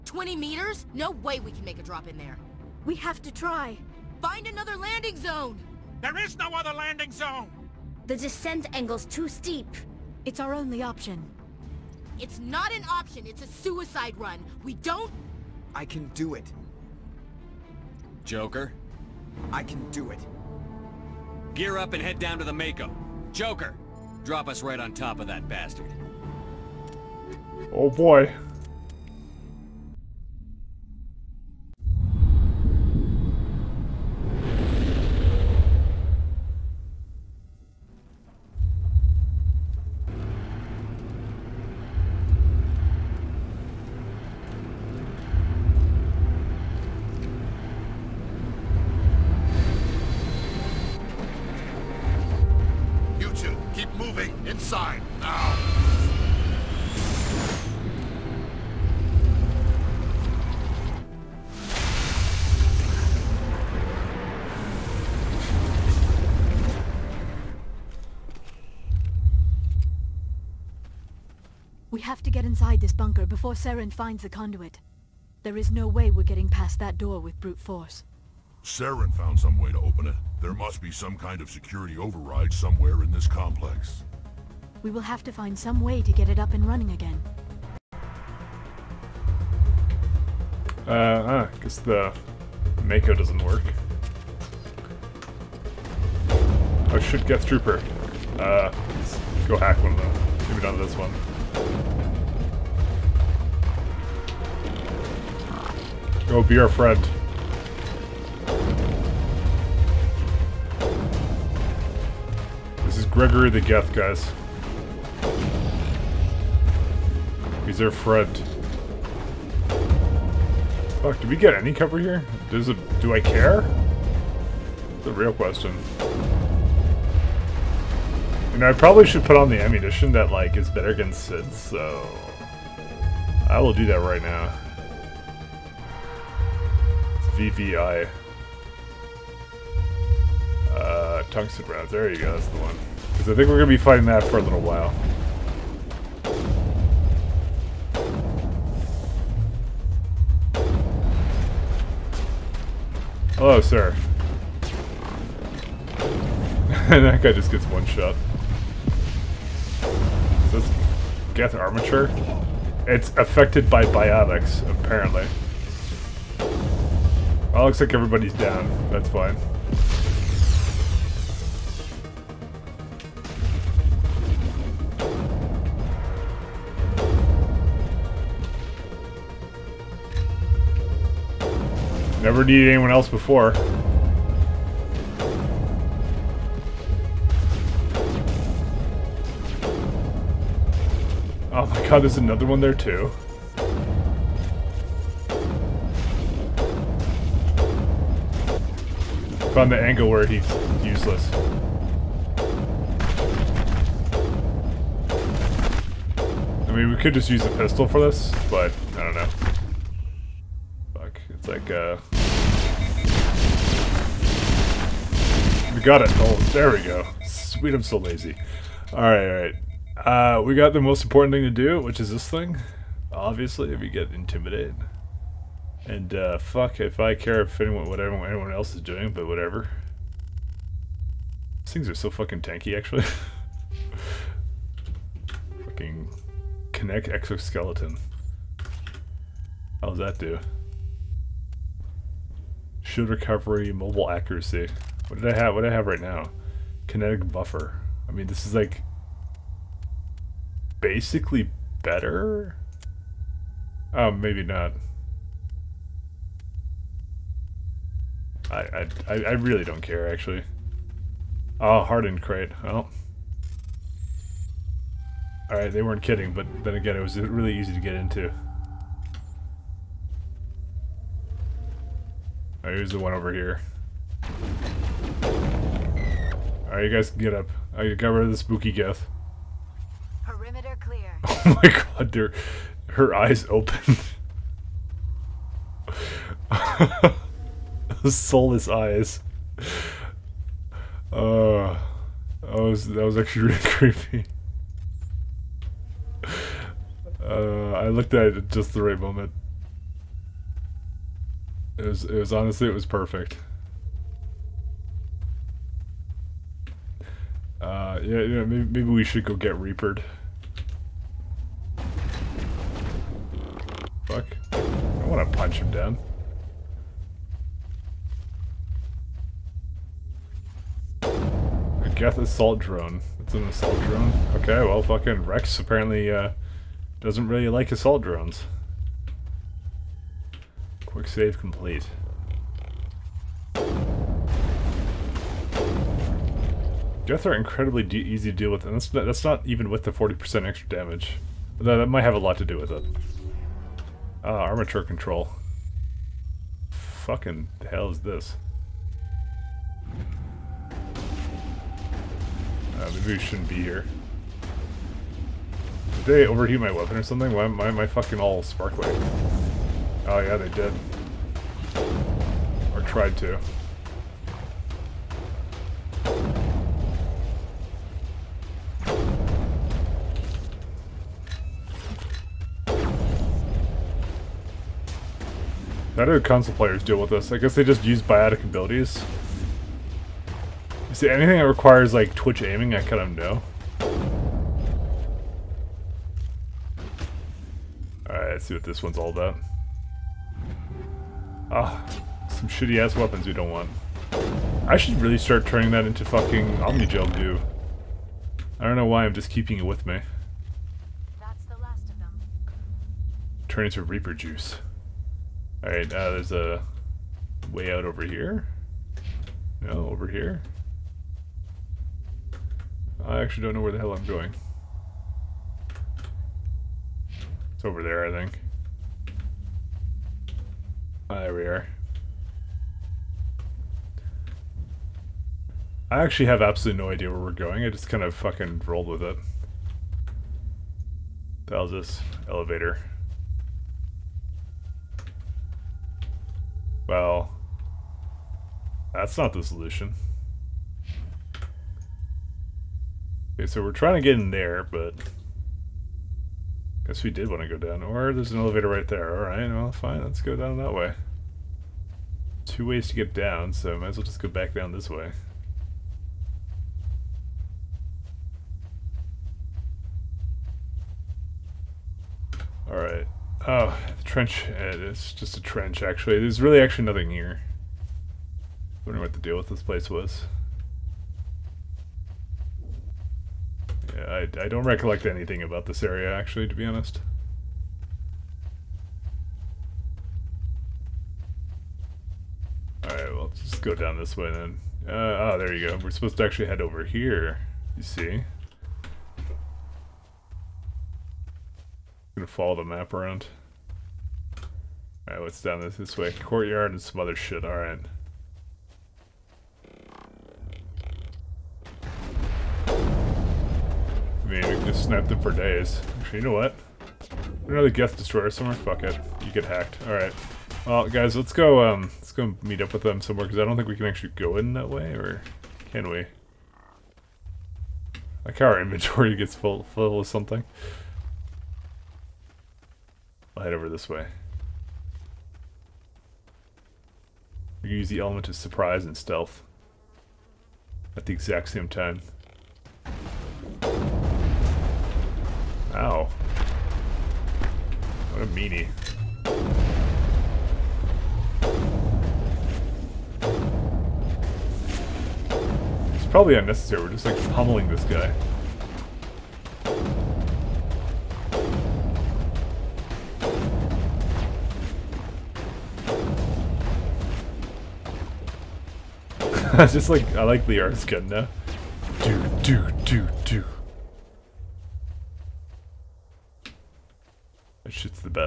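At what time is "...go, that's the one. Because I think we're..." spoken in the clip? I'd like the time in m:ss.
2:22.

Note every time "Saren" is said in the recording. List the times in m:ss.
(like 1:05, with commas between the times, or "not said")
1:13, 1:18.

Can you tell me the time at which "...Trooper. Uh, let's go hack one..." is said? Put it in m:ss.
1:37.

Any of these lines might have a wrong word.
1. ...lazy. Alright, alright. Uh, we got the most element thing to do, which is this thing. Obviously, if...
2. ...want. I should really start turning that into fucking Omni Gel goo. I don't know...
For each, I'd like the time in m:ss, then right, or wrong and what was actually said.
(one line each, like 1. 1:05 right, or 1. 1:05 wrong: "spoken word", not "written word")
1. 3:37 wrong: "important", not "element"
2. 6:33 right.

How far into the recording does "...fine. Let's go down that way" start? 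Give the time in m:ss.
7:29.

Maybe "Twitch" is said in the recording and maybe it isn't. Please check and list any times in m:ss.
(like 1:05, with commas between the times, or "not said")
6:22.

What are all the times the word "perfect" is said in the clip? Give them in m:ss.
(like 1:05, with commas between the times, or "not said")
5:02.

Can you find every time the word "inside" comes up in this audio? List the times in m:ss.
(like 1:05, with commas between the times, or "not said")
0:54, 1:12.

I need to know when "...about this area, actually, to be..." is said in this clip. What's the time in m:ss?
7:55.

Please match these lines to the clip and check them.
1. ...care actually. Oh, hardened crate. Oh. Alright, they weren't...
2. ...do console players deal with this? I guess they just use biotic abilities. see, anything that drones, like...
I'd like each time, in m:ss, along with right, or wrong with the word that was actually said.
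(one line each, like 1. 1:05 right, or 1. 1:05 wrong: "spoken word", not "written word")
1. 4:19 right
2. 6:16 wrong: "requires", not "drones".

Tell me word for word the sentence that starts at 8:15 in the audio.
Alright, what's down this, this way?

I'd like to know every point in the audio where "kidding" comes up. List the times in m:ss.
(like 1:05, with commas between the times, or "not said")
4:26.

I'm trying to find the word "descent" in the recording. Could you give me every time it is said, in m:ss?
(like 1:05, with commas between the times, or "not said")
0:08.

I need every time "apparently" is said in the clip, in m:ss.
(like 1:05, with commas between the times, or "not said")
2:44, 5:25.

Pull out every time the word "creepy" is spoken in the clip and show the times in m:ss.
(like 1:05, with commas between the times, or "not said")
4:53.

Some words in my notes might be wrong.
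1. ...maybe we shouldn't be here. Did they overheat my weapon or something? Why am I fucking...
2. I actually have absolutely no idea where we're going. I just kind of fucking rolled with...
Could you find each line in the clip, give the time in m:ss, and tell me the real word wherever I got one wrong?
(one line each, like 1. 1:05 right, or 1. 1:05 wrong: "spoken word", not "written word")
1. 5:53 right
2. 7:05 right.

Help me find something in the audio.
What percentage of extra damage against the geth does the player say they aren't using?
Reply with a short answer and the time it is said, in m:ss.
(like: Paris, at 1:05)
40%, at 5:39.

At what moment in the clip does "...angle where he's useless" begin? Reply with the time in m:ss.
3:19.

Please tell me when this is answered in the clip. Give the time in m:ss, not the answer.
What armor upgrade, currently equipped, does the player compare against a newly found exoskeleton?
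4:06.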